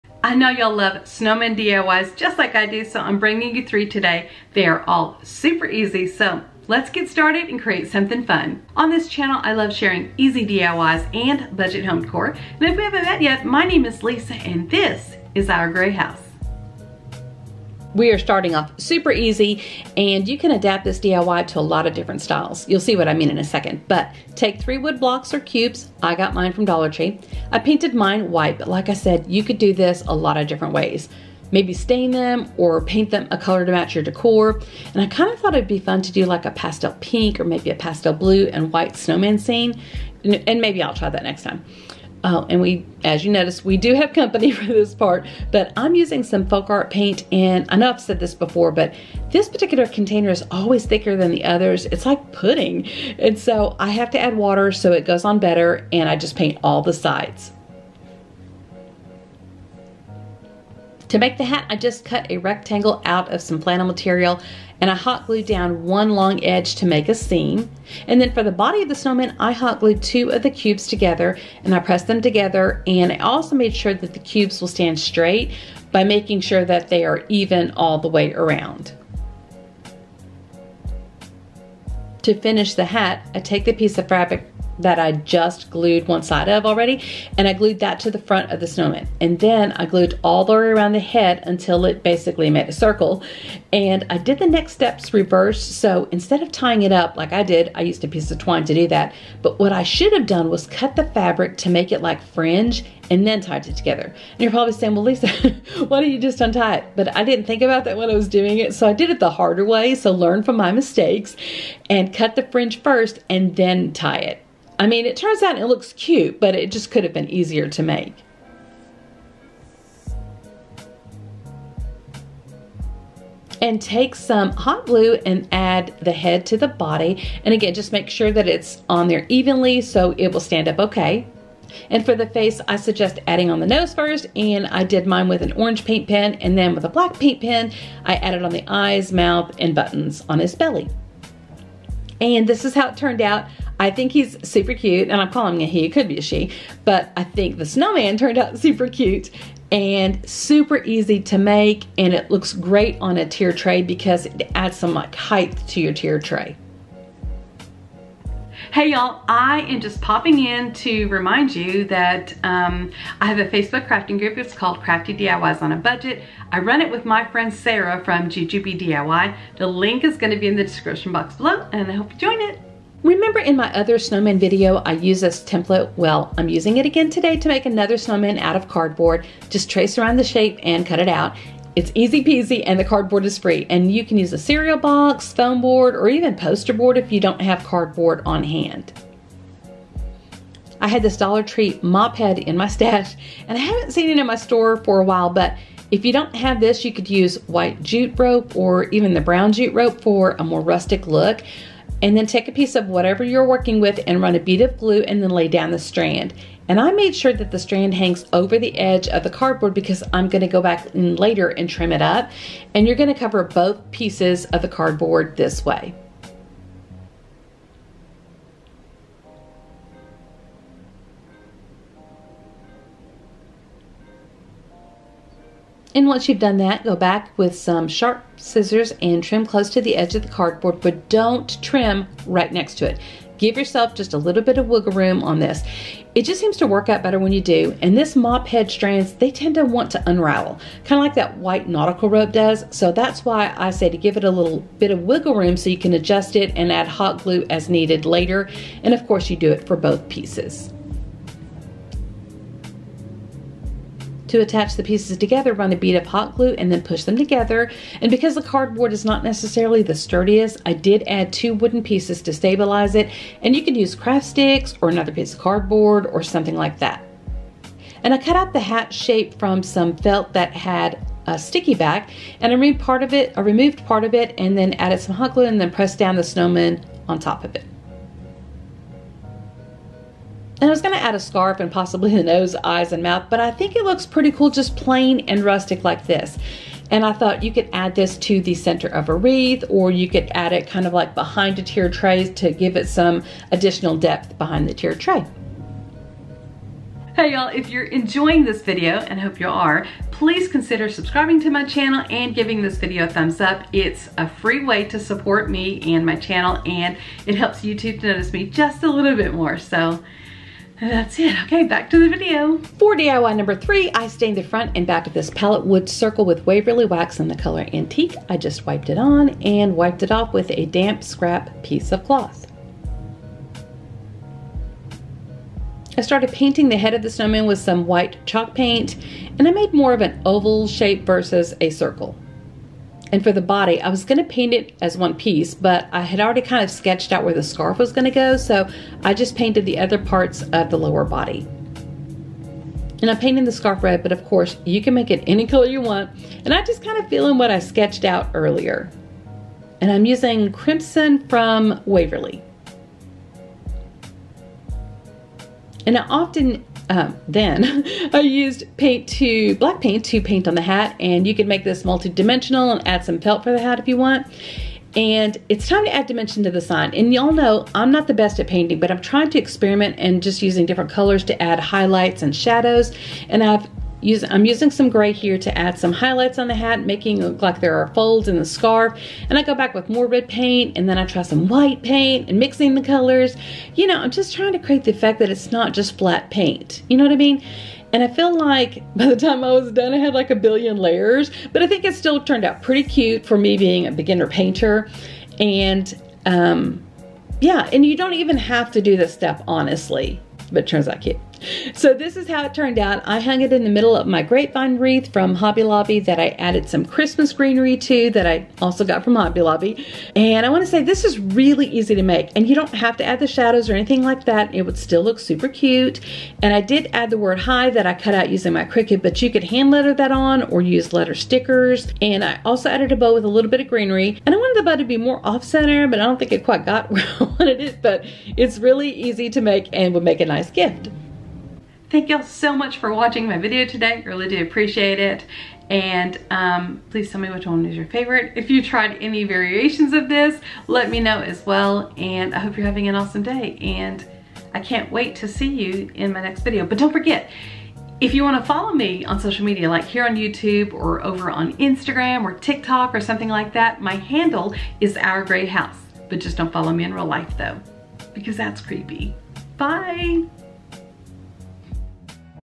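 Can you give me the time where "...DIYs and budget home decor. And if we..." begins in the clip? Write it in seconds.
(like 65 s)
10 s.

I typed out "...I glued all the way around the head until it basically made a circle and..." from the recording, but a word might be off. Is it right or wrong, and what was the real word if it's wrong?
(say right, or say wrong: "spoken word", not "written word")
right.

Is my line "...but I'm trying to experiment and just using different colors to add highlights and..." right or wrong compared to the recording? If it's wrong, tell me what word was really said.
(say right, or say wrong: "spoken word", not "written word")
right.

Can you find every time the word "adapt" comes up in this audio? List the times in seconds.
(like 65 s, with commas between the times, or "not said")
20 s.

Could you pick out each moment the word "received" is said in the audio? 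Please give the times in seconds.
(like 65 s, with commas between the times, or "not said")
not said.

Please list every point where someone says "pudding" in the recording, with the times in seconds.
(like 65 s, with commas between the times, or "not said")
52 s.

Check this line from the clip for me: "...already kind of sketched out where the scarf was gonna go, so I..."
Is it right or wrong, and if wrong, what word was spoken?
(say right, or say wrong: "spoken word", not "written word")
right.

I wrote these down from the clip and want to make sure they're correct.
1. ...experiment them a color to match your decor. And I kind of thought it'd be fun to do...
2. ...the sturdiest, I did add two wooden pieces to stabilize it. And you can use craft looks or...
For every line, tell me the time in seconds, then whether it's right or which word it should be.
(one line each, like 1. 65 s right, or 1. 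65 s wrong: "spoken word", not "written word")
1. 32 s wrong: "paint", not "experiment"
2. 259 s wrong: "sticks", not "looks".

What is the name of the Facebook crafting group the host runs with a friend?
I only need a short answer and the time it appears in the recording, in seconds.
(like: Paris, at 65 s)
Crafty DIYs on a Budget, at 164 s.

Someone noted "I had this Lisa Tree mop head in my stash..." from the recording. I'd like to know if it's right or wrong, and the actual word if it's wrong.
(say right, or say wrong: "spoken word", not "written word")
wrong: "Dollar", not "Lisa".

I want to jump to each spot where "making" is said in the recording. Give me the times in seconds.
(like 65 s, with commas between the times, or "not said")
76 s, 376 s.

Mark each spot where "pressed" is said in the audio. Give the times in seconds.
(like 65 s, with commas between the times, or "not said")
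71 s, 275 s.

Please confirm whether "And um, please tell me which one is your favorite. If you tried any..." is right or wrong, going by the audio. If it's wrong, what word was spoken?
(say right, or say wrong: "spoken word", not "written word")
right.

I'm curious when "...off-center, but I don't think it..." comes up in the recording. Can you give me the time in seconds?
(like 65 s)
425 s.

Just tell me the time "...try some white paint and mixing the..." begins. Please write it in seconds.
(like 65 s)
381 s.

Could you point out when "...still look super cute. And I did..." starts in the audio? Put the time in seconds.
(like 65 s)
414 s.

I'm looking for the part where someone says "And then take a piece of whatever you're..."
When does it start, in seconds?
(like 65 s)
202 s.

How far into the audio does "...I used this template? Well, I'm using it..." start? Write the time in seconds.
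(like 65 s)
174 s.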